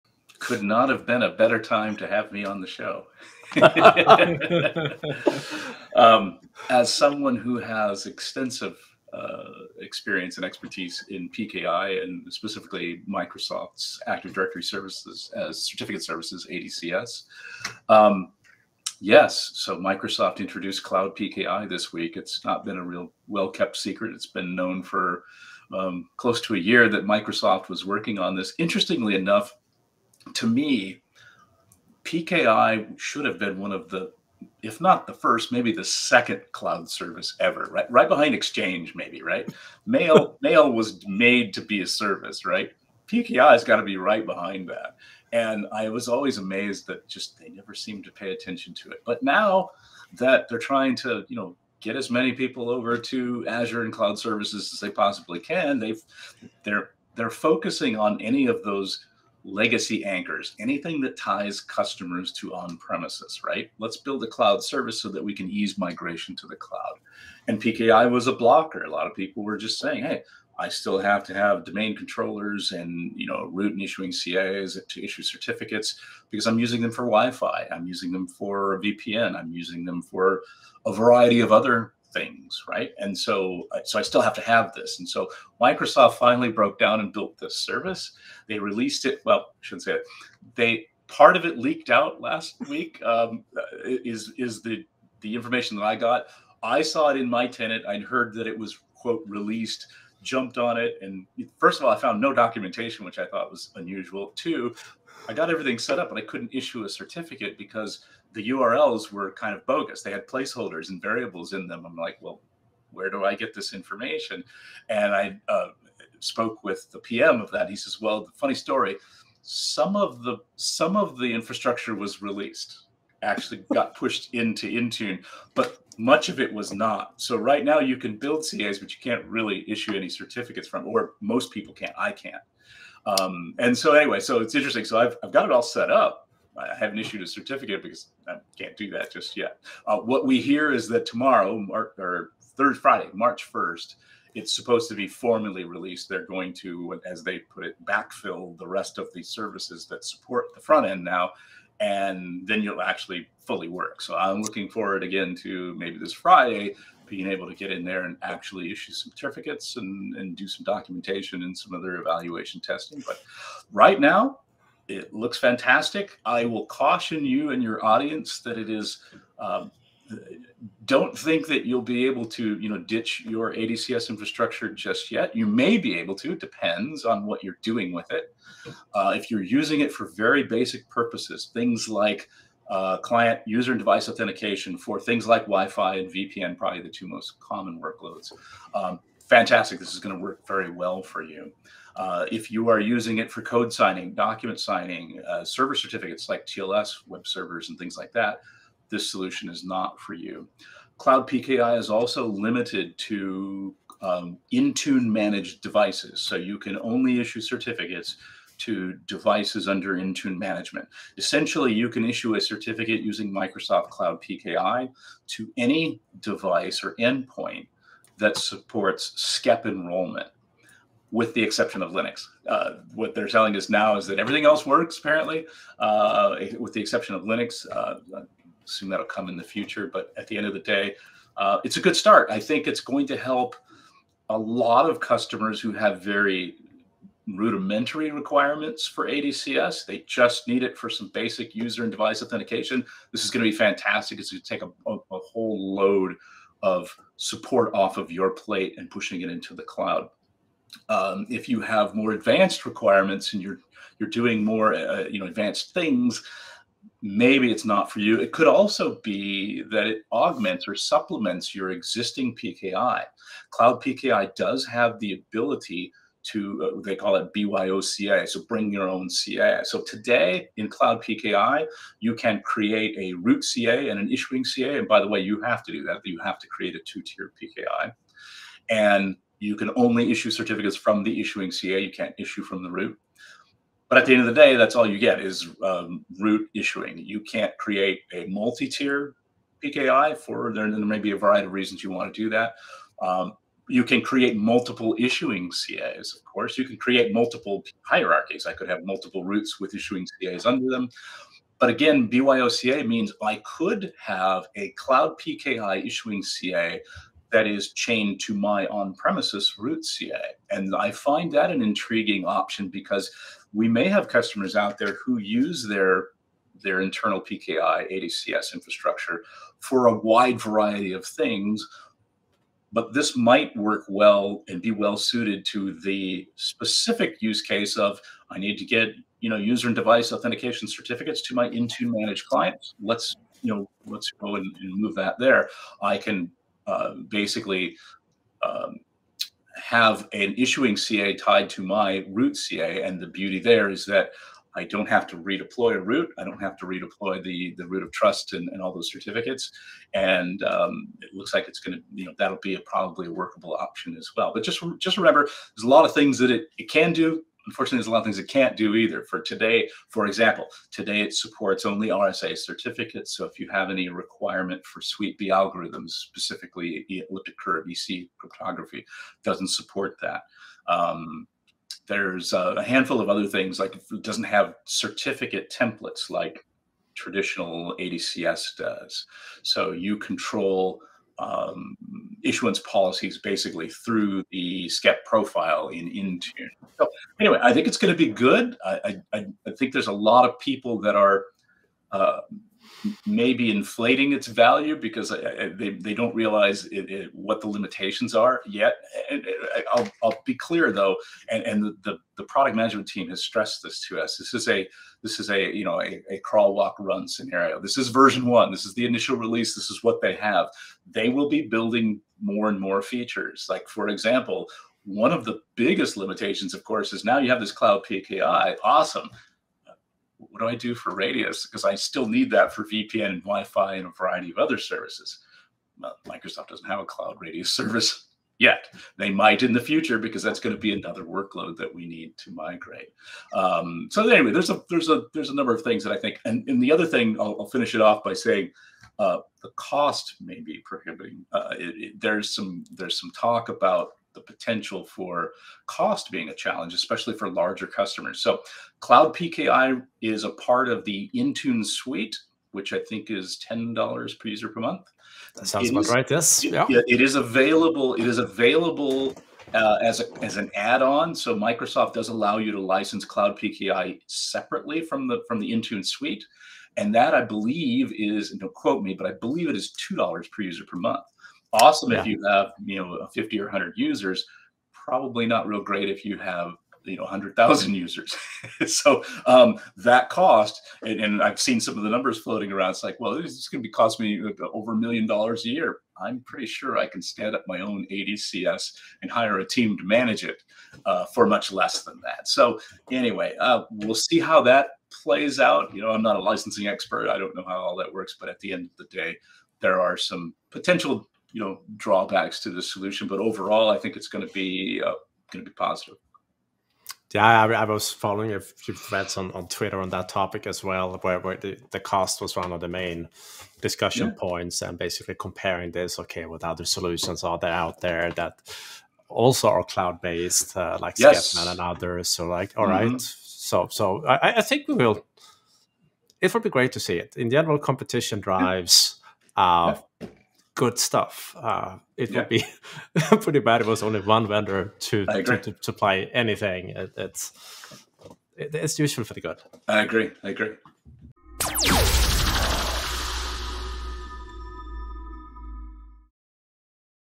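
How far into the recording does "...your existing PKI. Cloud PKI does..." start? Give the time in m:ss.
4:21.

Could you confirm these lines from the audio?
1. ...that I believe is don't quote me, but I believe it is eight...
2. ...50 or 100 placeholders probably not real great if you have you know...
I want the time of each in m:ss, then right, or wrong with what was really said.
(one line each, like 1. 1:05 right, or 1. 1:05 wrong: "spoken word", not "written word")
1. 7:46 wrong: "two", not "eight"
2. 7:53 wrong: "users", not "placeholders".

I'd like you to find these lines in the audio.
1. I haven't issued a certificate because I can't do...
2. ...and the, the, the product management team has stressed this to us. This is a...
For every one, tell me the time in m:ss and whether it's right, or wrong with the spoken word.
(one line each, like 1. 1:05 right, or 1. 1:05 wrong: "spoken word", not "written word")
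1. 2:16 right
2. 6:41 right.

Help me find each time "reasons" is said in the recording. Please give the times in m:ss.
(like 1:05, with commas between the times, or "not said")
4:51.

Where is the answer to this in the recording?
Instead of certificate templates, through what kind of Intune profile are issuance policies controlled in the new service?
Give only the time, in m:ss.
6:24.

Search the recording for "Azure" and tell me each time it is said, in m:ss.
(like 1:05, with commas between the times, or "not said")
0:53.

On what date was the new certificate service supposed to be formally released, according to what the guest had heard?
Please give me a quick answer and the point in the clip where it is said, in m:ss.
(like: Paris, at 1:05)
March 1st, at 2:23.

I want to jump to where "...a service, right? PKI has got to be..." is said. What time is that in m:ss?
0:41.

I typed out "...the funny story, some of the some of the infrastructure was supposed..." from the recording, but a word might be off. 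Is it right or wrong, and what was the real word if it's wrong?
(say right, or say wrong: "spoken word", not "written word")
wrong: "released", not "supposed".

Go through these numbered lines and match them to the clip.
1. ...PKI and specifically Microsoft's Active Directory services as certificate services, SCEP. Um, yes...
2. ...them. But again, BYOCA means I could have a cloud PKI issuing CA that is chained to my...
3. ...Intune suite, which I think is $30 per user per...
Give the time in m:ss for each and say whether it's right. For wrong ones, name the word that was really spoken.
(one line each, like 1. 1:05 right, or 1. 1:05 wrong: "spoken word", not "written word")
1. 0:11 wrong: "ADCS", not "SCEP"
2. 5:00 right
3. 7:31 wrong: "10", not "30".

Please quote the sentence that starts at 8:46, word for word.
It would be great to see it.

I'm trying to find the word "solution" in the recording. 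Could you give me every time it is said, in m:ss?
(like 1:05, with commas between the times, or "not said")
3:19, 8:22, 8:36.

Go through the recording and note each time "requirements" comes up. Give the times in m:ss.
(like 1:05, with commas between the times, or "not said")
3:58, 4:12, 6:03.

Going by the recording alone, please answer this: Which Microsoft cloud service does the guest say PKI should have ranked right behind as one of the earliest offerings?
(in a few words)
Exchange.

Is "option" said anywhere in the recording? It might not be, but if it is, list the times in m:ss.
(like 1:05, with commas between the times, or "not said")
5:12, 5:53.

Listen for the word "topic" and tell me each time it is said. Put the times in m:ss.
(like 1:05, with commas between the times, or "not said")
8:30.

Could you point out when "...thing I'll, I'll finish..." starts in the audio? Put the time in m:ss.
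7:16.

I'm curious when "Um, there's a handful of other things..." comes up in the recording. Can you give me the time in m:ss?
6:10.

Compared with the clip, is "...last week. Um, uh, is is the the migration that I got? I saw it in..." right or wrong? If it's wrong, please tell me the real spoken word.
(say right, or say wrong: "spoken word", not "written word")
wrong: "information", not "migration".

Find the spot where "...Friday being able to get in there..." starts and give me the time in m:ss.
2:36.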